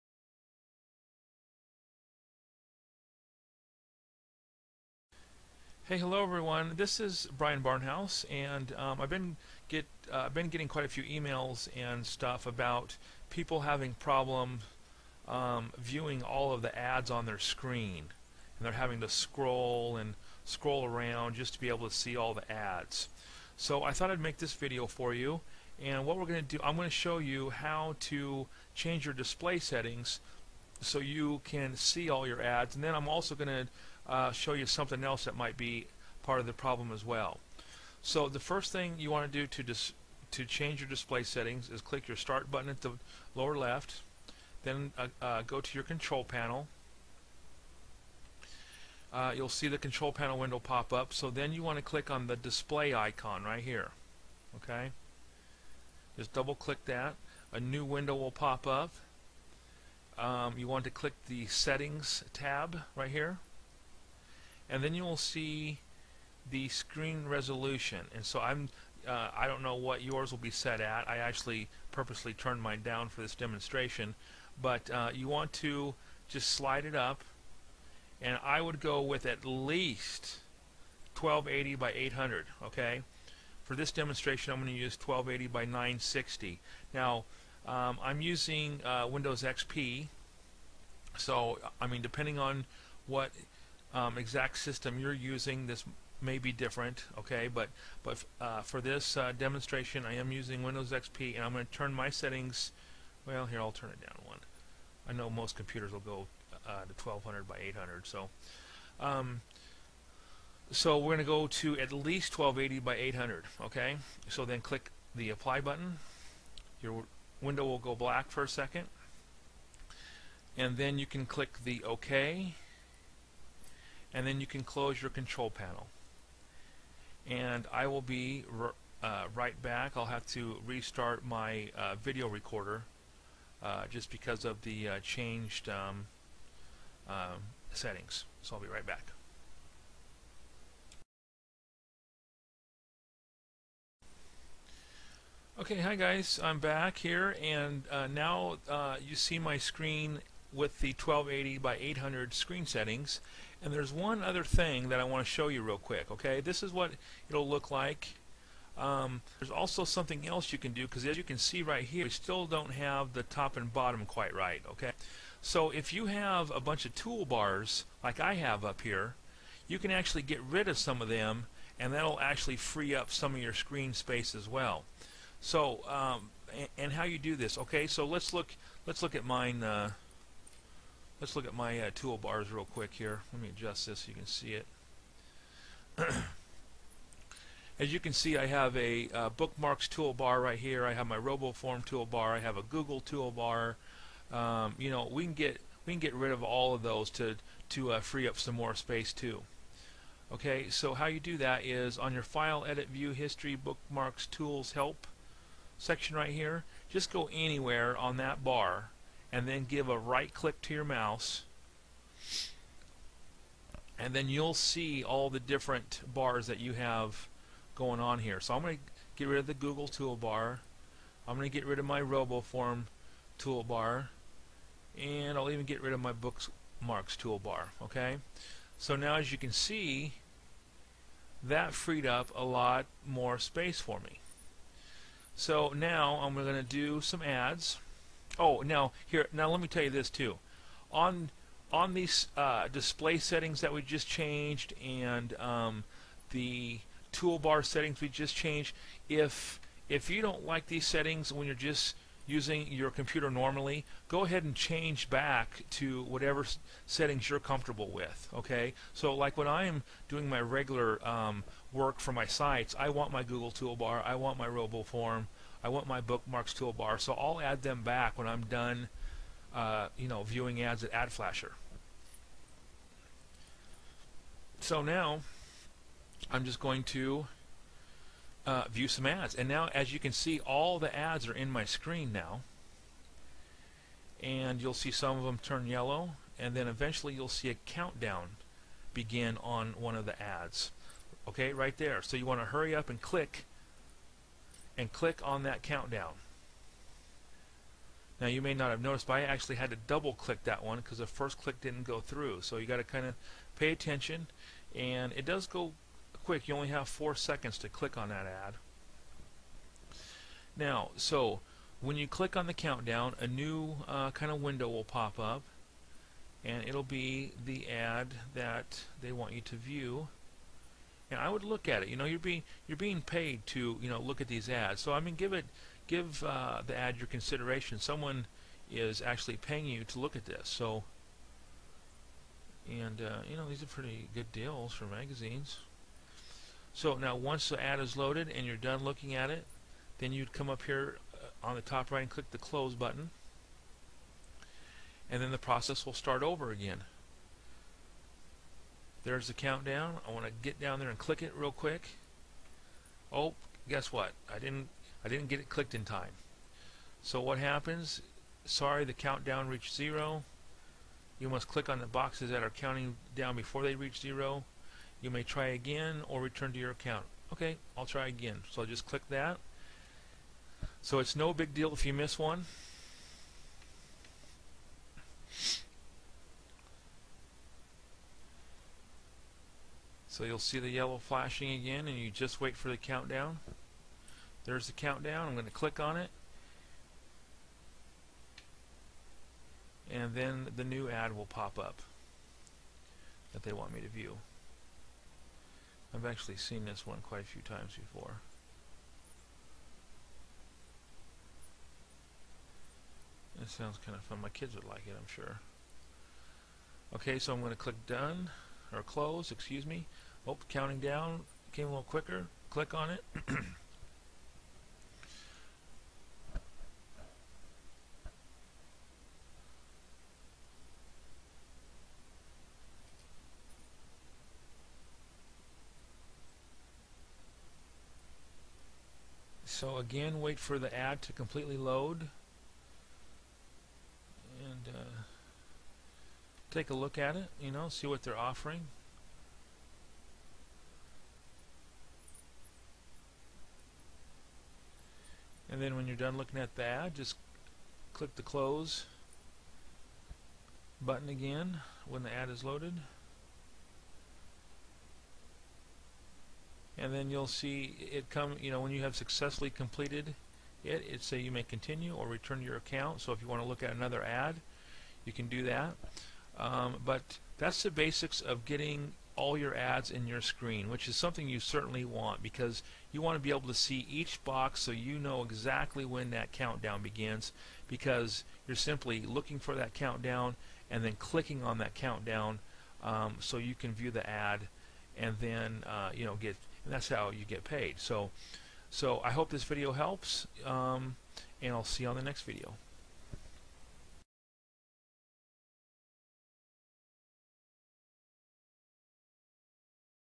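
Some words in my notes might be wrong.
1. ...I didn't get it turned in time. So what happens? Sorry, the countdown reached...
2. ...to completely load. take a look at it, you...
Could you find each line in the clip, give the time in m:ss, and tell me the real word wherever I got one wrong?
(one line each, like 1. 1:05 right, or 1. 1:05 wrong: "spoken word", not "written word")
1. 5:55 wrong: "clicked", not "turned"
2. 7:11 right.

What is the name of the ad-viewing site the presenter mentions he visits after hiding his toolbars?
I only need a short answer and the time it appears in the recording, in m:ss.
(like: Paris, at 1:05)
AdFlasher, at 4:30.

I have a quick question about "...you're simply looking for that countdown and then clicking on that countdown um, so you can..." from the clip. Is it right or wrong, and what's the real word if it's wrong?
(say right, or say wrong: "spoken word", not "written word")
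right.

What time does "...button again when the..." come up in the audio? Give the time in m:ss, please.
7:30.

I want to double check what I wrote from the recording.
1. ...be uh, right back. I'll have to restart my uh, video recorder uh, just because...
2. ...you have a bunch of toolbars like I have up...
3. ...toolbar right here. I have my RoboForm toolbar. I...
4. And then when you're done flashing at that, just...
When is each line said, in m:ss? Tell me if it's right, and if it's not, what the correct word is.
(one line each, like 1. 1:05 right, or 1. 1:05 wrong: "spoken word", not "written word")
1. 2:08 right
2. 2:45 right
3. 3:09 right
4. 7:25 wrong: "looking", not "flashing".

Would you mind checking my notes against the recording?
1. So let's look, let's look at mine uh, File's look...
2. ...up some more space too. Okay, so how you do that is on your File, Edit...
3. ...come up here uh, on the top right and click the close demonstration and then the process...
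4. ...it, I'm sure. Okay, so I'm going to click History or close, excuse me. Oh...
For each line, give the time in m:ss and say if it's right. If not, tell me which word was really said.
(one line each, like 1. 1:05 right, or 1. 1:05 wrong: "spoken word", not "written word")
1. 2:57 wrong: "Let", not "File"
2. 3:18 right
3. 5:40 wrong: "button", not "demonstration"
4. 6:44 wrong: "Done", not "History".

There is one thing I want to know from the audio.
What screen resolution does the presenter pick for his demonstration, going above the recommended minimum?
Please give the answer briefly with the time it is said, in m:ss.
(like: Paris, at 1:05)
1280 by 960, at 1:24.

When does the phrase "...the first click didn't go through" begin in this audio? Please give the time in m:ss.
5:00.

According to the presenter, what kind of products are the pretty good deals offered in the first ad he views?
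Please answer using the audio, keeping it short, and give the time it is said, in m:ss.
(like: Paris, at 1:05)
magazines, at 5:34.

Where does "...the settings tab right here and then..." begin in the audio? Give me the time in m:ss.
1:01.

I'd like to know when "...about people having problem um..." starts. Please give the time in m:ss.
0:12.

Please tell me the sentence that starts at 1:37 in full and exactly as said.
But but uh, for this uh, demonstration, I am using Windows XP, and I'm going to turn my settings.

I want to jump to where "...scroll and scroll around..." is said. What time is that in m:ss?
0:19.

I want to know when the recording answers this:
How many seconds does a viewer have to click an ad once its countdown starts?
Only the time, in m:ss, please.
5:06.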